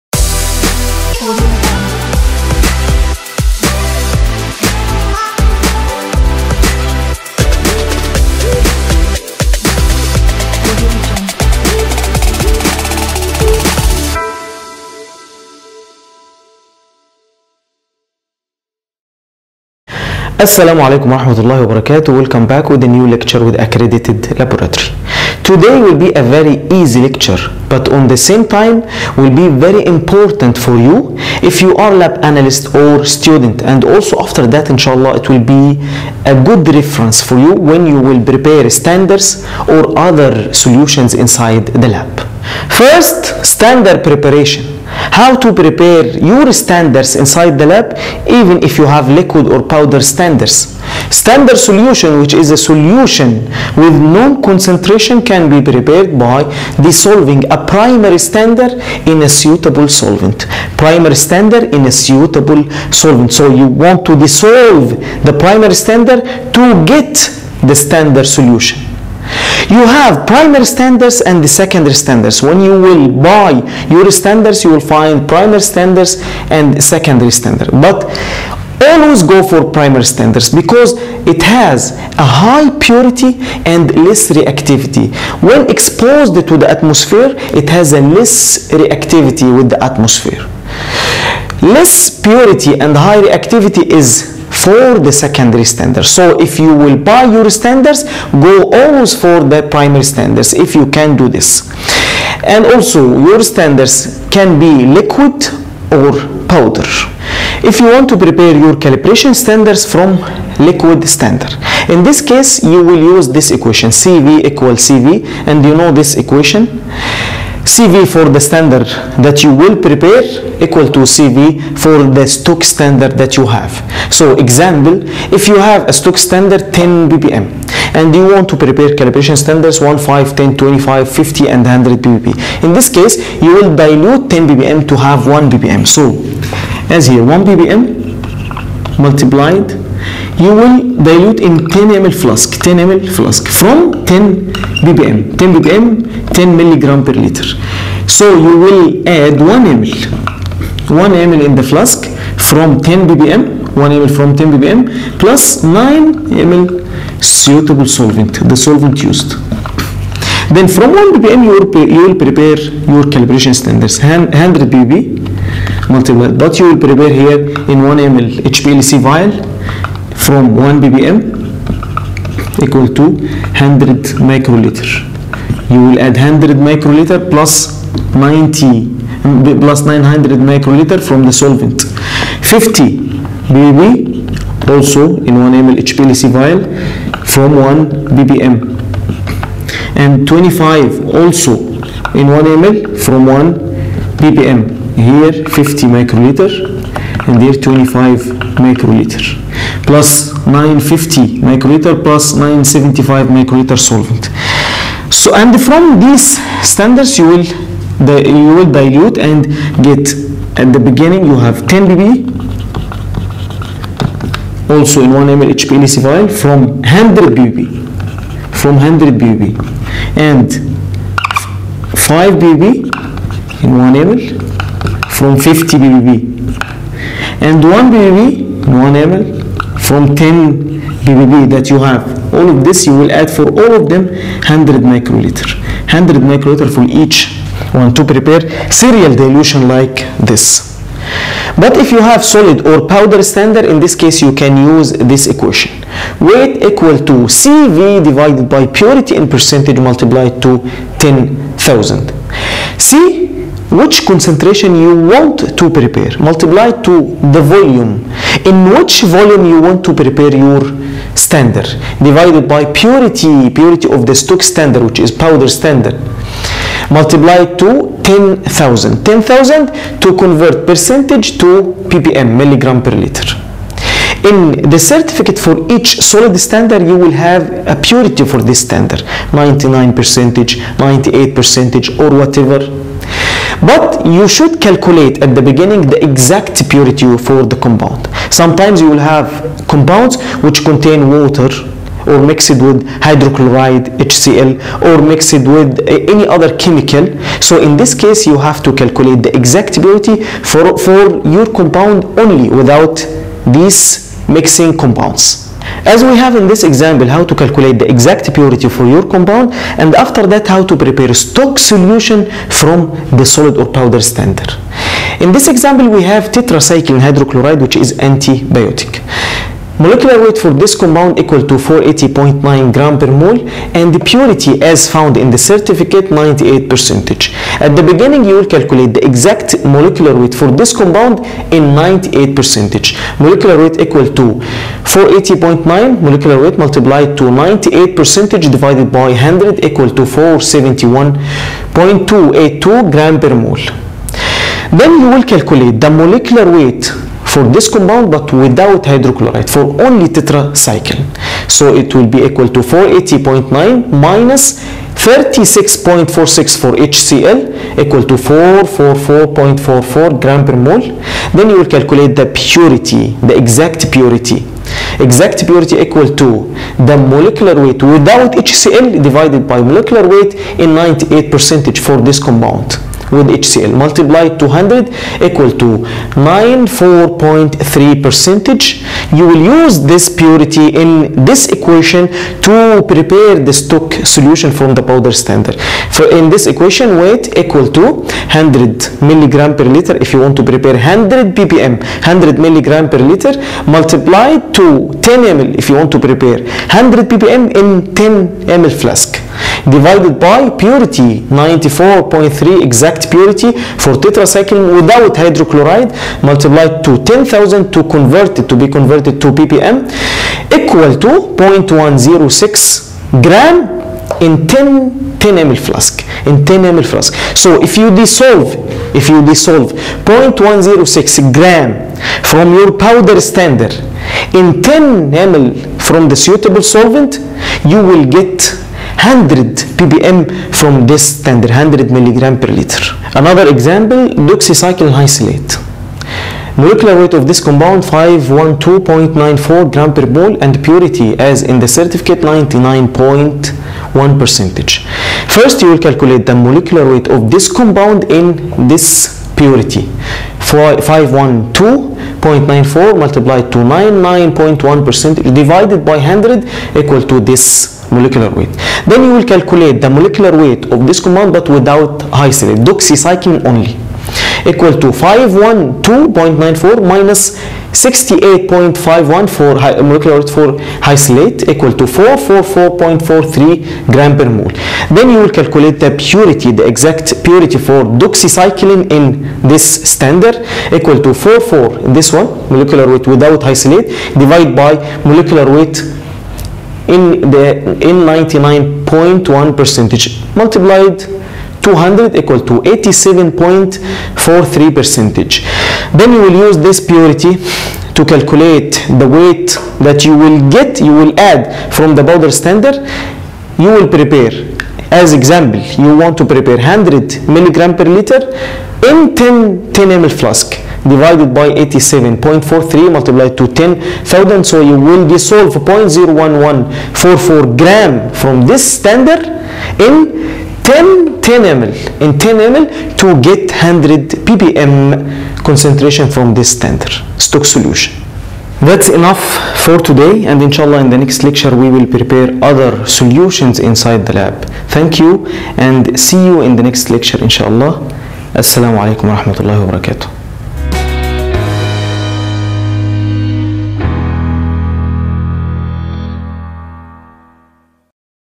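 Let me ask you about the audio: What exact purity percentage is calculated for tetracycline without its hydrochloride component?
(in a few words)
94.3.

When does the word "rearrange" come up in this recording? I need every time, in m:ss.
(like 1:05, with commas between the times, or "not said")
not said.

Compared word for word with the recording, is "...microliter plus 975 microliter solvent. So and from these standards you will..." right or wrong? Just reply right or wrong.
right.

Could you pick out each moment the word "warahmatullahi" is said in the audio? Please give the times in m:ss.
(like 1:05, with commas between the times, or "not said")
0:21.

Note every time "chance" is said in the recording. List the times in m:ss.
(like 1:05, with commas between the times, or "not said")
not said.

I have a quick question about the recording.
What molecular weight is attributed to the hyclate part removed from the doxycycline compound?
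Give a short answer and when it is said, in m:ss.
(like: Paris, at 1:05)
68.51, at 7:47.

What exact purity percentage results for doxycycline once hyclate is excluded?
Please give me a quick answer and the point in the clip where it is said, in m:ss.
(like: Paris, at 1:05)
87.43, at 8:12.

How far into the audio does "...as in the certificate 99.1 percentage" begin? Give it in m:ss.
7:21.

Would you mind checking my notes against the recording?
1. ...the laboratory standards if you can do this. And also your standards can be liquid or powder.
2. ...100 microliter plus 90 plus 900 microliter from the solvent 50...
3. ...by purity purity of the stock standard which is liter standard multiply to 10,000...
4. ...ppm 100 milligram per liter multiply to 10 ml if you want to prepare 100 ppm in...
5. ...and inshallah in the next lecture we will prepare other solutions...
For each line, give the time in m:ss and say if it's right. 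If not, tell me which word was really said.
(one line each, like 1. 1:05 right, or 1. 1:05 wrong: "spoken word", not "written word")
1. 1:39 wrong: "primary", not "laboratory"
2. 2:56 right
3. 4:22 wrong: "powder", not "liter"
4. 6:31 right
5. 8:50 right.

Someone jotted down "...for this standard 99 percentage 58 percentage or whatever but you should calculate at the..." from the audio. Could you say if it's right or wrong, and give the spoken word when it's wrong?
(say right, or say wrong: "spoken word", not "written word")
wrong: "98", not "58".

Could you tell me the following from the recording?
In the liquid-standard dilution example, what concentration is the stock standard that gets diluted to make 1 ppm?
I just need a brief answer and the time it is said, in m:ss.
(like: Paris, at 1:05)
10 ppm, at 2:05.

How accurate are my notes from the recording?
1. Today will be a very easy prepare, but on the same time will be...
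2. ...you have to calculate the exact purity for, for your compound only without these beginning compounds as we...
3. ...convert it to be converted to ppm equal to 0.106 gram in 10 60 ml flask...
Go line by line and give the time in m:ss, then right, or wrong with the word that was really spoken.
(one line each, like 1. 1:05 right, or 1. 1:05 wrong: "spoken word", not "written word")
1. 0:25 wrong: "lecture", not "prepare"
2. 4:58 wrong: "mixing", not "beginning"
3. 6:47 wrong: "10", not "60".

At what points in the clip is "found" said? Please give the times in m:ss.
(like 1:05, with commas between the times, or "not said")
5:24.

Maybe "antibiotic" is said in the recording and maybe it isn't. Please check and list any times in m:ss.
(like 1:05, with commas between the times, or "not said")
5:17.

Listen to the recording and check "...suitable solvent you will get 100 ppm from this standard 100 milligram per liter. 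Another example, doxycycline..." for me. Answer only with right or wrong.
right.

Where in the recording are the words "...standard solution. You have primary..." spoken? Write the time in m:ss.
1:07.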